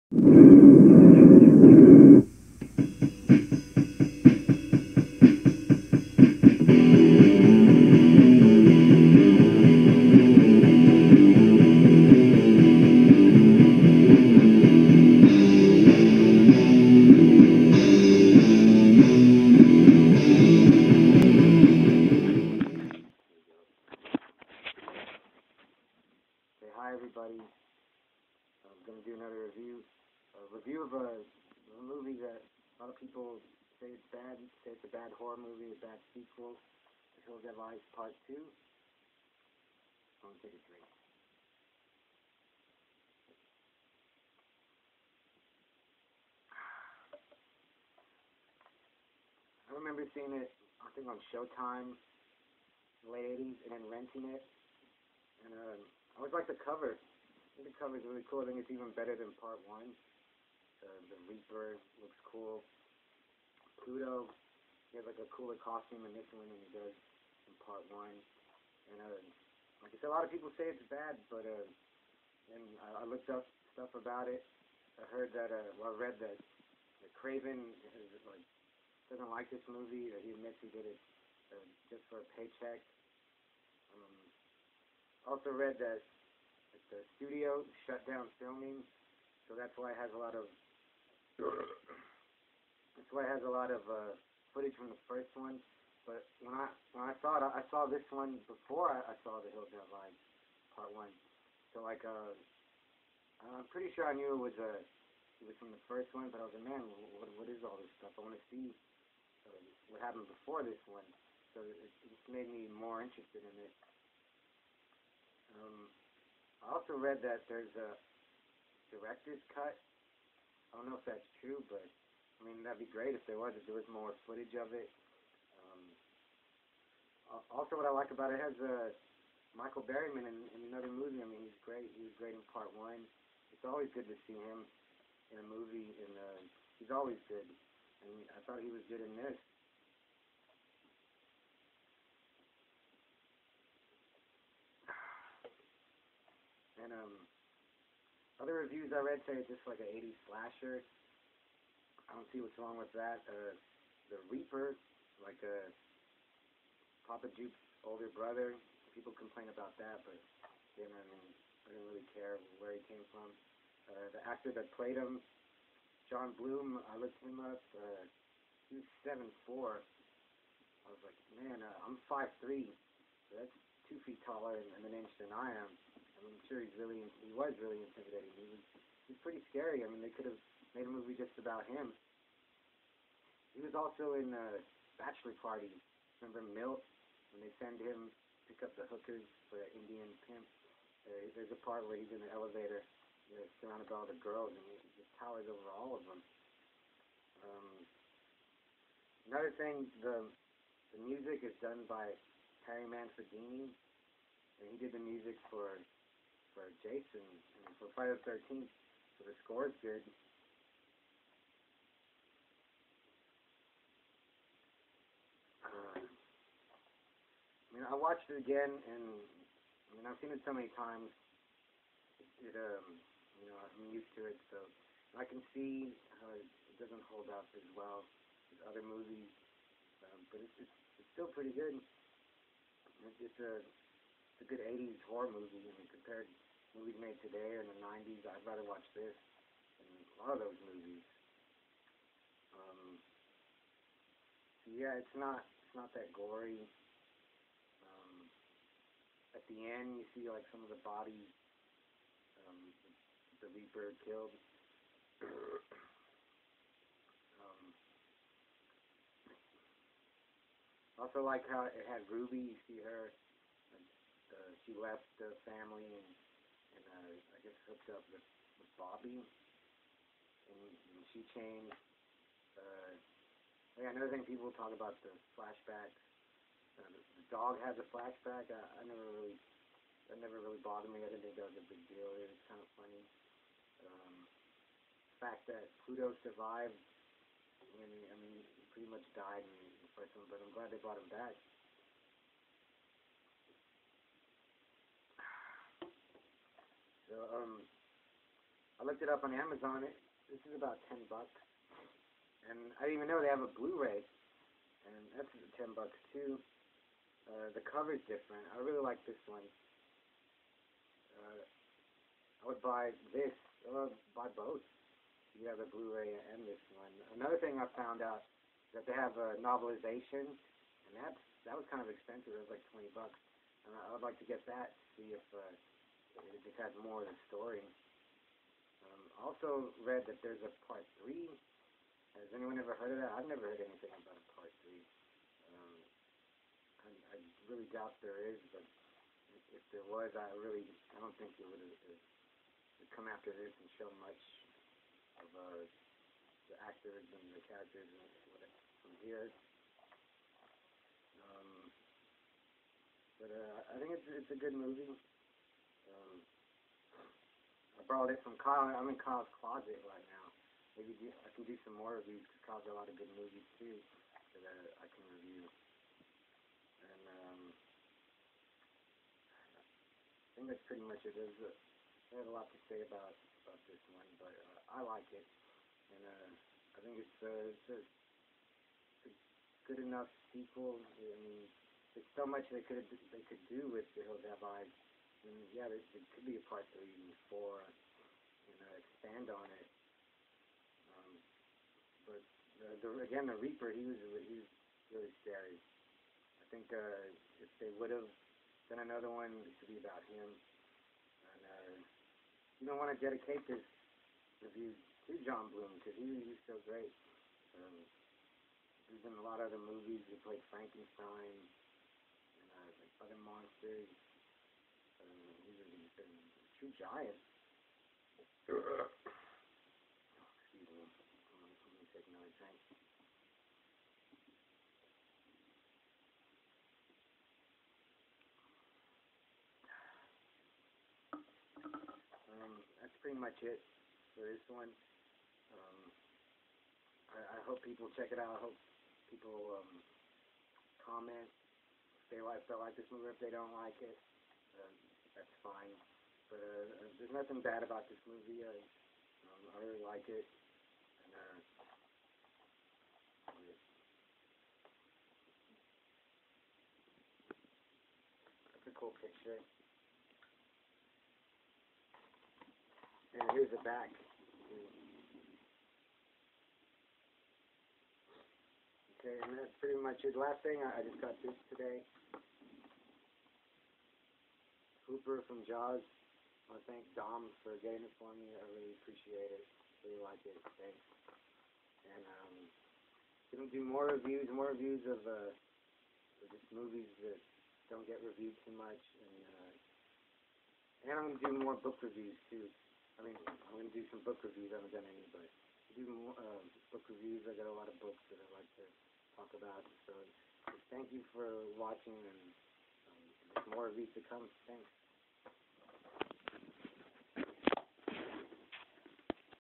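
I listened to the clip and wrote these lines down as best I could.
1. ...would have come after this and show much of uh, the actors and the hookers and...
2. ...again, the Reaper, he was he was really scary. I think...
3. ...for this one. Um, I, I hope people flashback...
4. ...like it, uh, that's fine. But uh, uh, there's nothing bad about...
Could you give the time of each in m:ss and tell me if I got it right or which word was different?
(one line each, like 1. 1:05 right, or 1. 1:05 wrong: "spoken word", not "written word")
1. 5:41 wrong: "characters", not "hookers"
2. 6:33 right
3. 7:14 wrong: "check", not "flashback"
4. 7:23 right.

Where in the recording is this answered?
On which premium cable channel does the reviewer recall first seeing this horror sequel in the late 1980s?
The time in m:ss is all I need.
0:51.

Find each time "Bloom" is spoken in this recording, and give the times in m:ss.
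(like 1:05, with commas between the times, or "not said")
2:46, 6:45.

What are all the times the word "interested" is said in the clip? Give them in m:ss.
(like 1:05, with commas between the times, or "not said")
1:53.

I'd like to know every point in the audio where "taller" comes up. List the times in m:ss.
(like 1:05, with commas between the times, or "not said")
2:54.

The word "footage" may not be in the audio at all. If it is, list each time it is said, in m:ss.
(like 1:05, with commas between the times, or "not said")
1:34, 2:04.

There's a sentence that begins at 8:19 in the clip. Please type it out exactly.
So thank you for watching, and um, there's more of these to come.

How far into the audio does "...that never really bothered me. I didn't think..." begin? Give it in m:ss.
4:40.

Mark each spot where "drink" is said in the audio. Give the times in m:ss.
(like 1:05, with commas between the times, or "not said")
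0:40, 7:02.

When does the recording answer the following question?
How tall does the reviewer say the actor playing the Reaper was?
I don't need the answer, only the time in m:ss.
2:49.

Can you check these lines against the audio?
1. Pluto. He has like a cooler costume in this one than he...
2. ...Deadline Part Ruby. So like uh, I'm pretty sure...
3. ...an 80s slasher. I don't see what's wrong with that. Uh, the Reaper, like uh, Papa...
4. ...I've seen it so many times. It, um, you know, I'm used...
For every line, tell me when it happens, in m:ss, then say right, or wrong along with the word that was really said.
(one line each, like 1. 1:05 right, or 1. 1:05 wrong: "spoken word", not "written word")
1. 1:03 right
2. 1:39 wrong: "One", not "Ruby"
3. 2:29 right
4. 3:40 right.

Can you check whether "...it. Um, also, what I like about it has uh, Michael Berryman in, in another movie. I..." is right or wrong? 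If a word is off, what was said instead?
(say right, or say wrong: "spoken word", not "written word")
right.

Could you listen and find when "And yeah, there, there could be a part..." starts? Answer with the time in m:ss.
6:25.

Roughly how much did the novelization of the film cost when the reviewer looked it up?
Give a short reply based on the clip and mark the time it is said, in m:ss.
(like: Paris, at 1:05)
$20, at 5:22.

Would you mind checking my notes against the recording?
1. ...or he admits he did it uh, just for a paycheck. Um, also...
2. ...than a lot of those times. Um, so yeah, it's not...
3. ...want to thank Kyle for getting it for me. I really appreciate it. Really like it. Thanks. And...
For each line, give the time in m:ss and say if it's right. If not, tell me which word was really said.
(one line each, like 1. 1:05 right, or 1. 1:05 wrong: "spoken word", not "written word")
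1. 1:20 right
2. 3:59 wrong: "movies", not "times"
3. 7:56 wrong: "Dom", not "Kyle".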